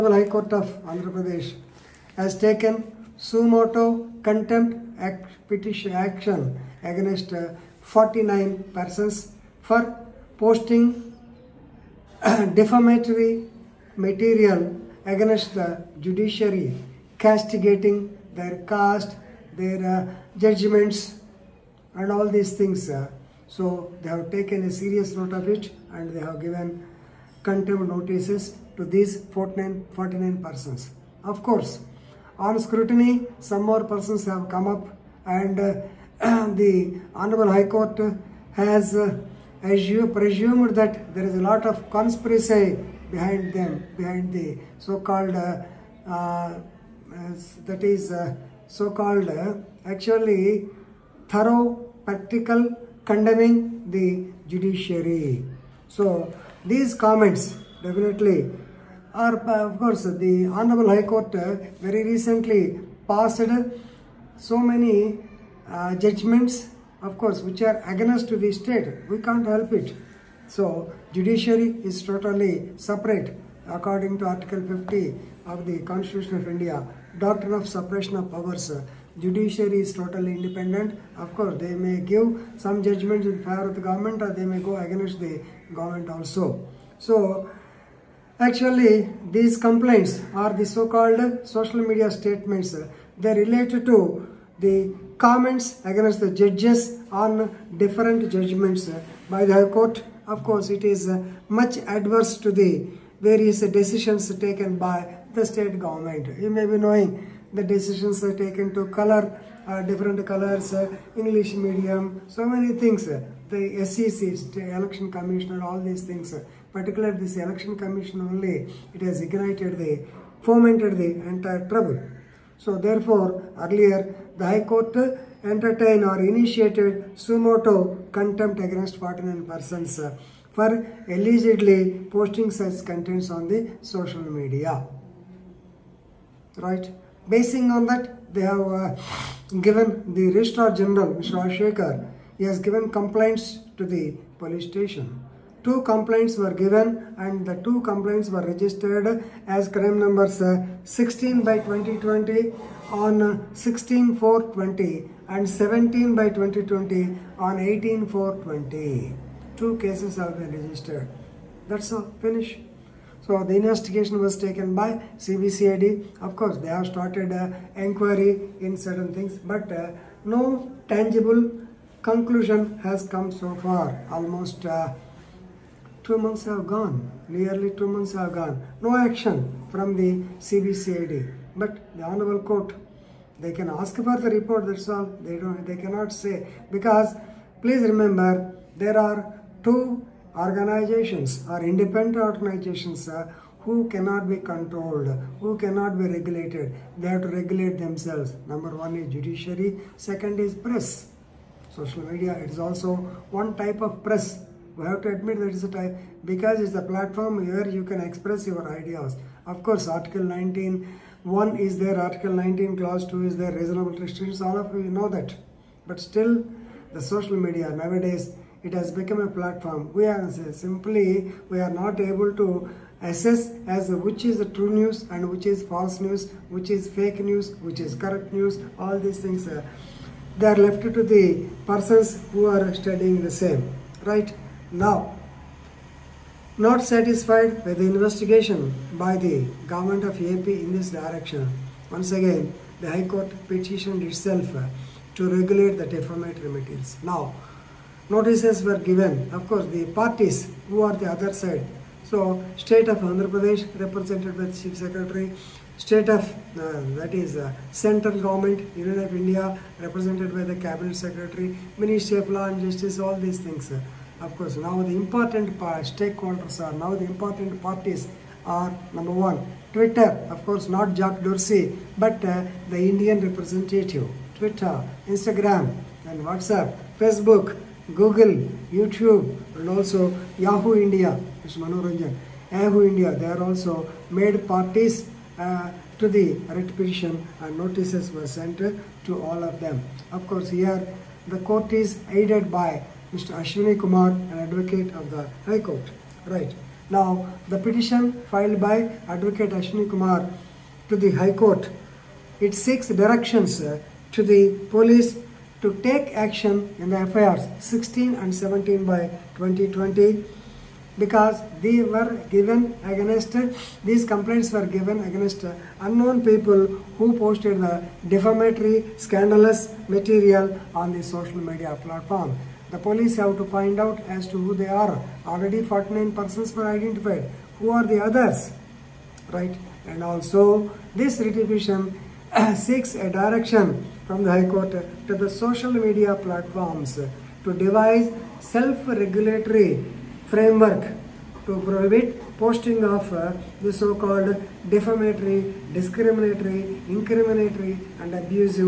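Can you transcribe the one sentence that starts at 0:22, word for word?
Uh, so they have taken a serious note of it and they have given contempt notices to these 49, 49 persons.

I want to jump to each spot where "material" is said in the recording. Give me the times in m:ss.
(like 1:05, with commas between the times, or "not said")
0:13, 4:06, 5:19.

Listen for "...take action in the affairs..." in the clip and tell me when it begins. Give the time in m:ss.
5:05.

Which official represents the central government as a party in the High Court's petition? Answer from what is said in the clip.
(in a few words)
Cabinet Secretary.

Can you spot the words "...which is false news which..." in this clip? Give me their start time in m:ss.
3:45.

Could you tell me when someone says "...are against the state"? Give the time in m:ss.
1:07.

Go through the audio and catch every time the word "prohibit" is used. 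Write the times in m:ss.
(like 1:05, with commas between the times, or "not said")
5:41.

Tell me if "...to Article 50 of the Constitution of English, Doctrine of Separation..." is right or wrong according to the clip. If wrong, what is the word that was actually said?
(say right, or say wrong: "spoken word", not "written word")
wrong: "India", not "English".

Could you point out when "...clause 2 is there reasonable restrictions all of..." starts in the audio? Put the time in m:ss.
3:32.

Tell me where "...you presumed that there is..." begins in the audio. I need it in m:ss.
0:39.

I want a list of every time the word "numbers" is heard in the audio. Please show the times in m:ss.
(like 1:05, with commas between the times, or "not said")
2:29, 3:18, 4:28.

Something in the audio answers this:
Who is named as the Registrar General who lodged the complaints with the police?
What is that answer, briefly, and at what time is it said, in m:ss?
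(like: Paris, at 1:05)
Ashekar, at 2:21.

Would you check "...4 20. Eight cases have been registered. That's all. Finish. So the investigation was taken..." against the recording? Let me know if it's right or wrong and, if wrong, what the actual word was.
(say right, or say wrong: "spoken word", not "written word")
wrong: "Two", not "Eight".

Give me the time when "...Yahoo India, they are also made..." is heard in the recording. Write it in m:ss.
4:42.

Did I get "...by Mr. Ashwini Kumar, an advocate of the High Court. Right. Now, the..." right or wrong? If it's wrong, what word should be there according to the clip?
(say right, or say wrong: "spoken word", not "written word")
right.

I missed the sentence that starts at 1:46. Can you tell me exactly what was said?
You may be knowing the decisions are taken to color uh, different colors, uh, English medium, so many things.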